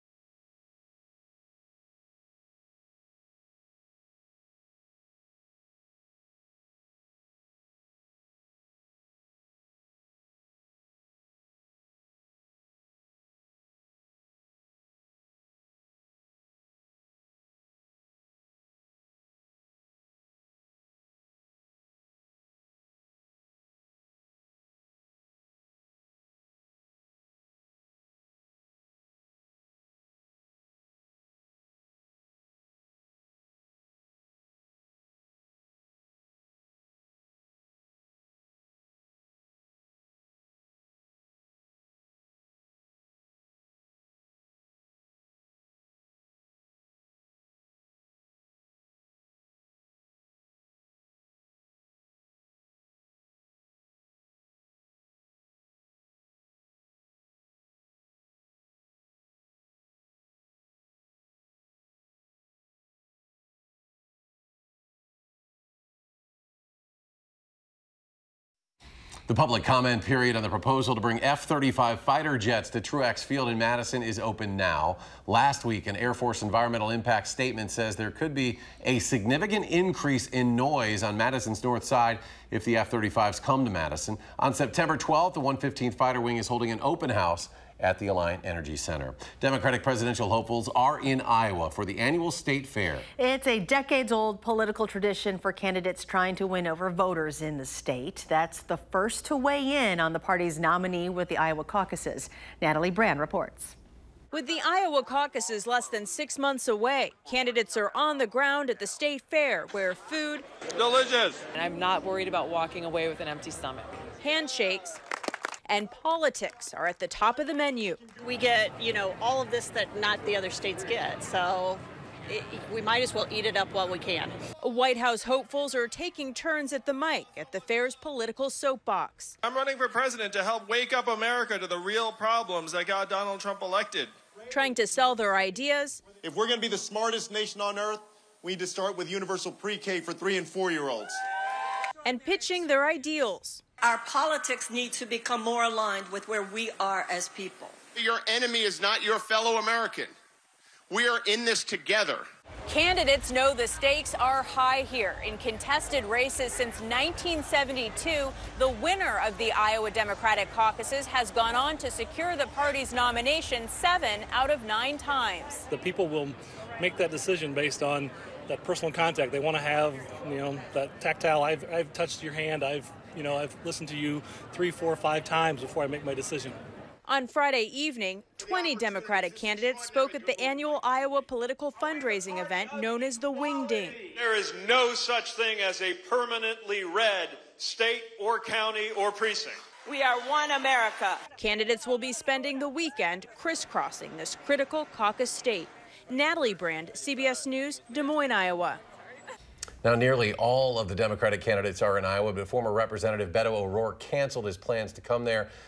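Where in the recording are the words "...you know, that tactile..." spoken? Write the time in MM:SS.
02:50.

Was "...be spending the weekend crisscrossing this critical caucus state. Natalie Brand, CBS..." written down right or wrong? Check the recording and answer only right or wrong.
right.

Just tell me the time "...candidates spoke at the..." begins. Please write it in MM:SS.
02:59.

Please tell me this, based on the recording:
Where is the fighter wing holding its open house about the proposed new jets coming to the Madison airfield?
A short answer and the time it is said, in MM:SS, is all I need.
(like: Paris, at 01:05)
Alliant Energy Center, at 01:28.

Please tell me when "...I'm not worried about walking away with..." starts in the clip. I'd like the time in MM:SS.
01:51.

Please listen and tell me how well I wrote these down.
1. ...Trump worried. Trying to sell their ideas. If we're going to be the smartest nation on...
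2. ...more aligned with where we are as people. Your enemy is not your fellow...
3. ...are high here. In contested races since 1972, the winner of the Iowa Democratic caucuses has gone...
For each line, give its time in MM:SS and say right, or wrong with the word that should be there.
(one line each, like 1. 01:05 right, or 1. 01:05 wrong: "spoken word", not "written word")
1. 02:13 wrong: "elected", not "worried"
2. 02:25 right
3. 02:34 right.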